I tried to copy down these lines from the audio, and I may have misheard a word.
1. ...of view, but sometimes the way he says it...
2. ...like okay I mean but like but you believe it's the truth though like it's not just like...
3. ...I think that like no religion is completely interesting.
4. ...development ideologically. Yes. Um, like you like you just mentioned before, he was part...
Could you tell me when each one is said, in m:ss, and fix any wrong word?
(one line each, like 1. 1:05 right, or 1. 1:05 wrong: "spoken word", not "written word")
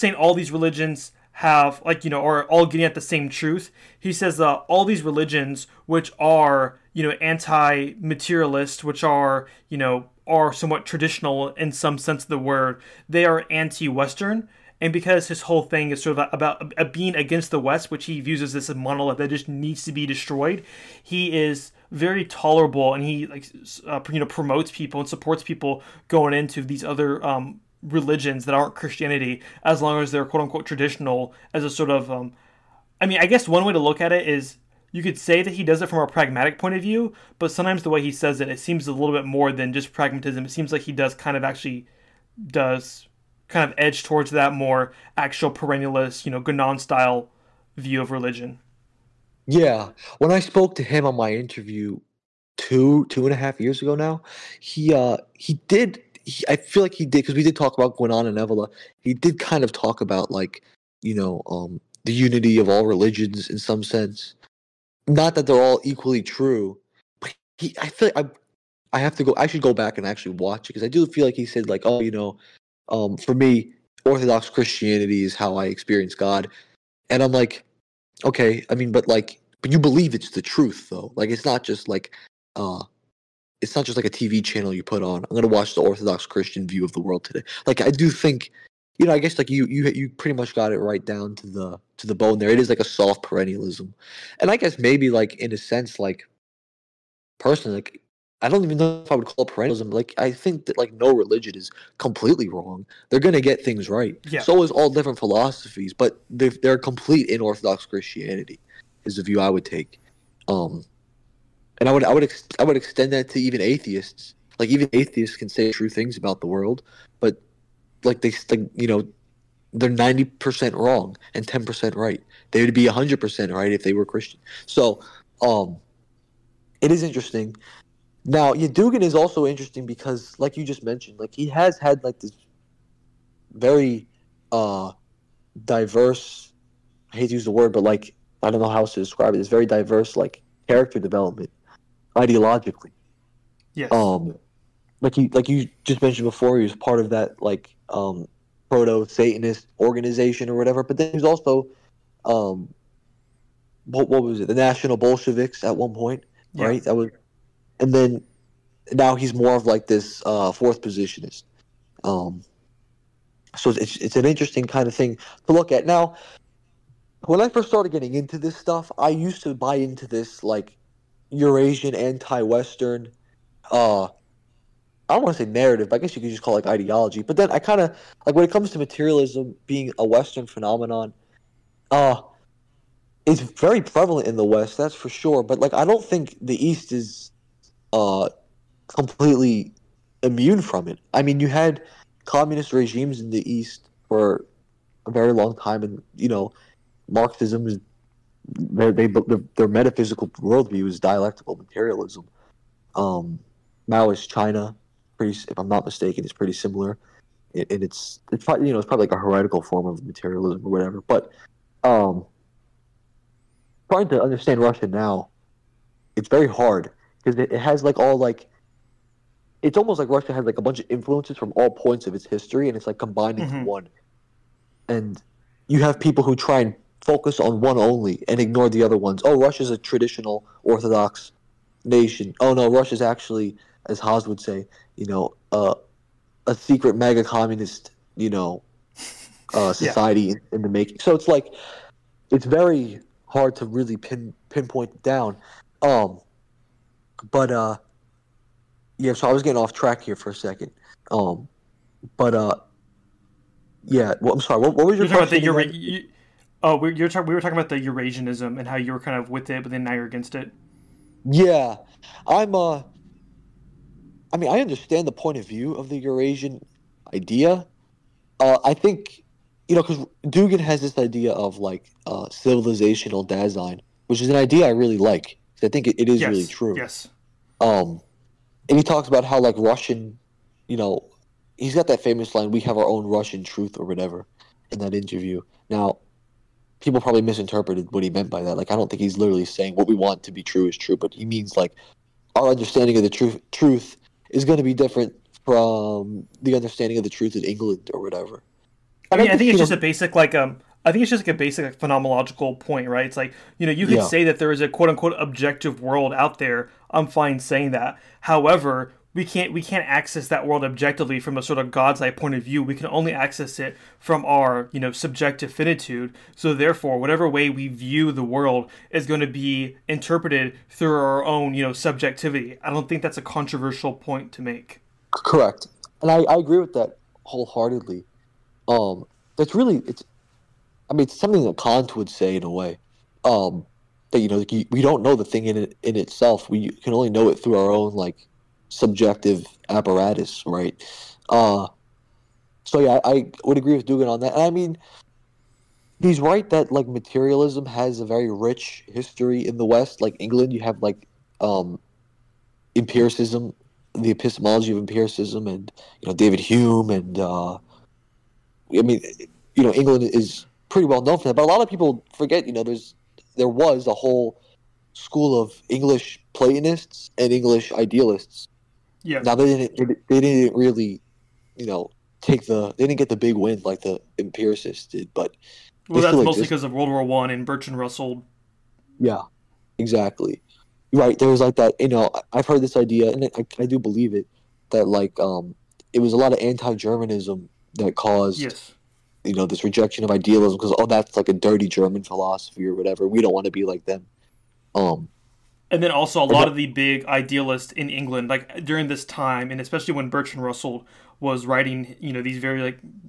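1. 0:36 right
2. 1:17 right
3. 1:40 wrong: "wrong", not "interesting"
4. 2:20 right.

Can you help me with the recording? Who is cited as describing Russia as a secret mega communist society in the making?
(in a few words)
Haas.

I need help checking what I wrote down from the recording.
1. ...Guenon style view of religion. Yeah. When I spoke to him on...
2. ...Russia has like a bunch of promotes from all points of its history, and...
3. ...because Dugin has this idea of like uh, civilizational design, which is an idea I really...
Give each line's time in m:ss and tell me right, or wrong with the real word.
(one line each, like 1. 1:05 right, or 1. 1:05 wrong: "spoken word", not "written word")
1. 0:46 right
2. 3:40 wrong: "influences", not "promotes"
3. 4:29 right.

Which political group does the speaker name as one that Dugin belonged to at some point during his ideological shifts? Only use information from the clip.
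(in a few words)
National Bolsheviks.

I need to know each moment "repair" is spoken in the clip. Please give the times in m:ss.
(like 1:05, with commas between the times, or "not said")
not said.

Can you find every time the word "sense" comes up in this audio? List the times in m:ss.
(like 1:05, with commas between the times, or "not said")
0:11, 1:03, 1:35.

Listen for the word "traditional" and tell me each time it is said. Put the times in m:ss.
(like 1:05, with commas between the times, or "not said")
0:10, 0:30, 3:49.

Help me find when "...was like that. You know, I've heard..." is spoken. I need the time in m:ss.
6:21.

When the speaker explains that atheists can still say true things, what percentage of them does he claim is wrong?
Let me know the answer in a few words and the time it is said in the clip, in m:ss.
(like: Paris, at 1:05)
90 percent, at 1:59.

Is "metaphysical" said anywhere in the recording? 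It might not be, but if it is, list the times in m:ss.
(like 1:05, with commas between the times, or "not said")
3:19.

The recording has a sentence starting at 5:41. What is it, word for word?
Uh, so yeah, I, I would agree with Dugin on that.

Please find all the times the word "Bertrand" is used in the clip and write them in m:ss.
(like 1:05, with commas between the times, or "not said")
6:17, 6:40.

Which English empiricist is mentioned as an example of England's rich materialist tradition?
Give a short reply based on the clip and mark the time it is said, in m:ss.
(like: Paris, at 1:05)
David Hume, at 5:56.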